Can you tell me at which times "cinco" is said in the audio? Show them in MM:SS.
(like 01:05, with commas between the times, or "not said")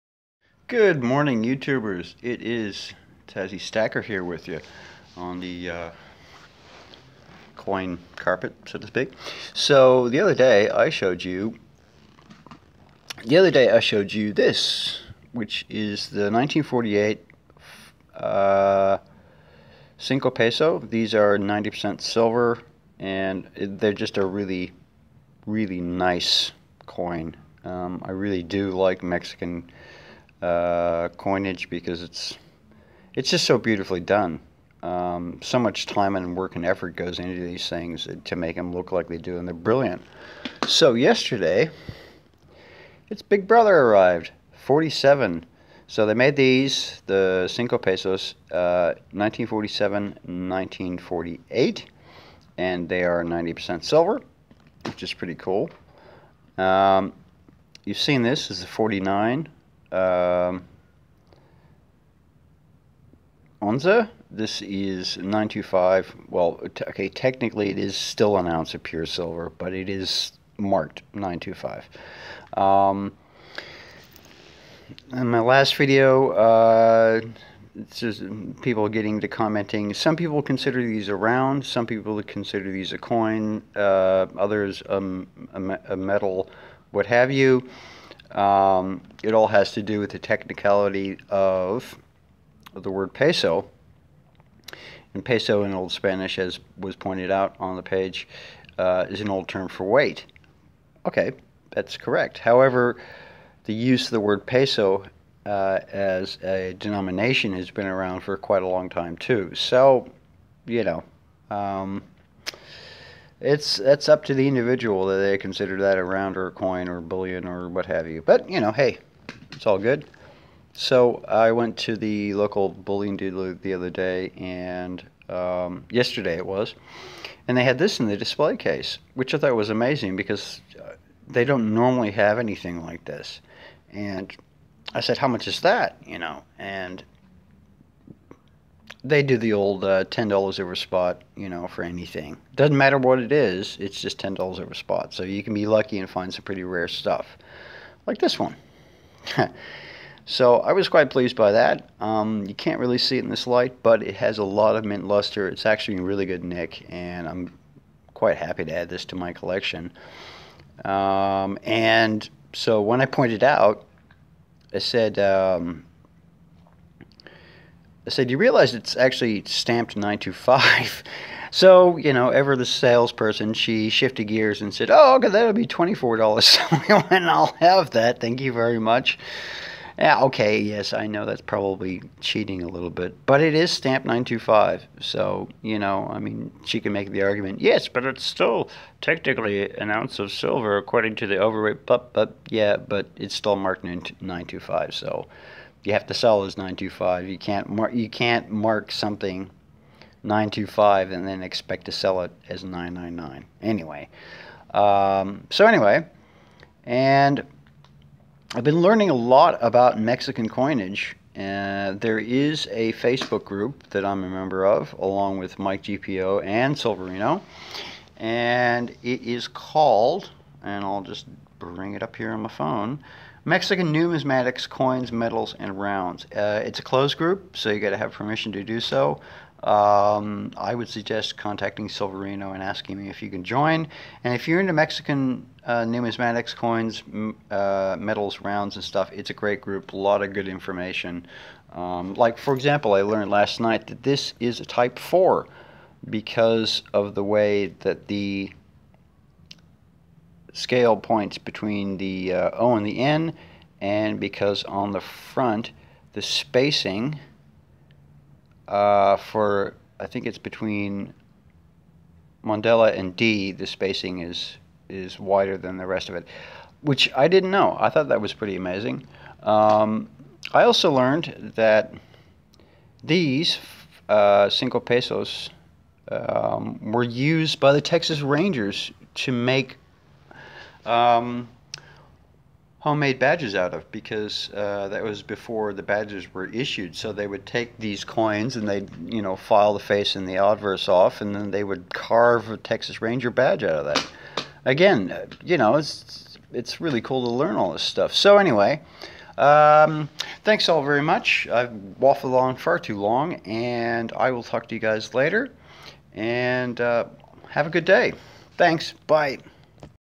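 00:19, 00:47, 04:34.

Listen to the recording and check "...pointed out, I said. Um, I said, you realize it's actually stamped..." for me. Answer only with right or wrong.
right.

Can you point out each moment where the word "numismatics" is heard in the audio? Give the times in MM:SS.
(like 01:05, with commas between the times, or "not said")
03:43, 03:55.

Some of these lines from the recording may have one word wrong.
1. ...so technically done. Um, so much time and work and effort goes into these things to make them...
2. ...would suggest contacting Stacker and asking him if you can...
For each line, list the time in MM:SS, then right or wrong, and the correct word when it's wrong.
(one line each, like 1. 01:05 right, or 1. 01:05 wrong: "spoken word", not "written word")
1. 00:33 wrong: "beautifully", not "technically"
2. 03:50 wrong: "Silverino", not "Stacker".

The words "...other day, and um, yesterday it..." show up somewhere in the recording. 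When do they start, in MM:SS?
02:03.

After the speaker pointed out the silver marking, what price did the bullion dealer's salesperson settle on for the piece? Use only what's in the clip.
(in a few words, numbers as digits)
$24.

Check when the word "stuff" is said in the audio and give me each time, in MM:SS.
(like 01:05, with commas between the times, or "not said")
02:26, 03:58, 04:57.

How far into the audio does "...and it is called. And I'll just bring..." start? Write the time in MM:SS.
03:38.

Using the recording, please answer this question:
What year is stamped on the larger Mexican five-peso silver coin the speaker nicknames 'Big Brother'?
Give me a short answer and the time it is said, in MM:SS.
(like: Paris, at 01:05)
1947, at 00:44.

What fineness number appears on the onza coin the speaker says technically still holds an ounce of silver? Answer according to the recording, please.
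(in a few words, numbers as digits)
925.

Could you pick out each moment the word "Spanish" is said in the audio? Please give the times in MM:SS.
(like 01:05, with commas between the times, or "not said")
01:35.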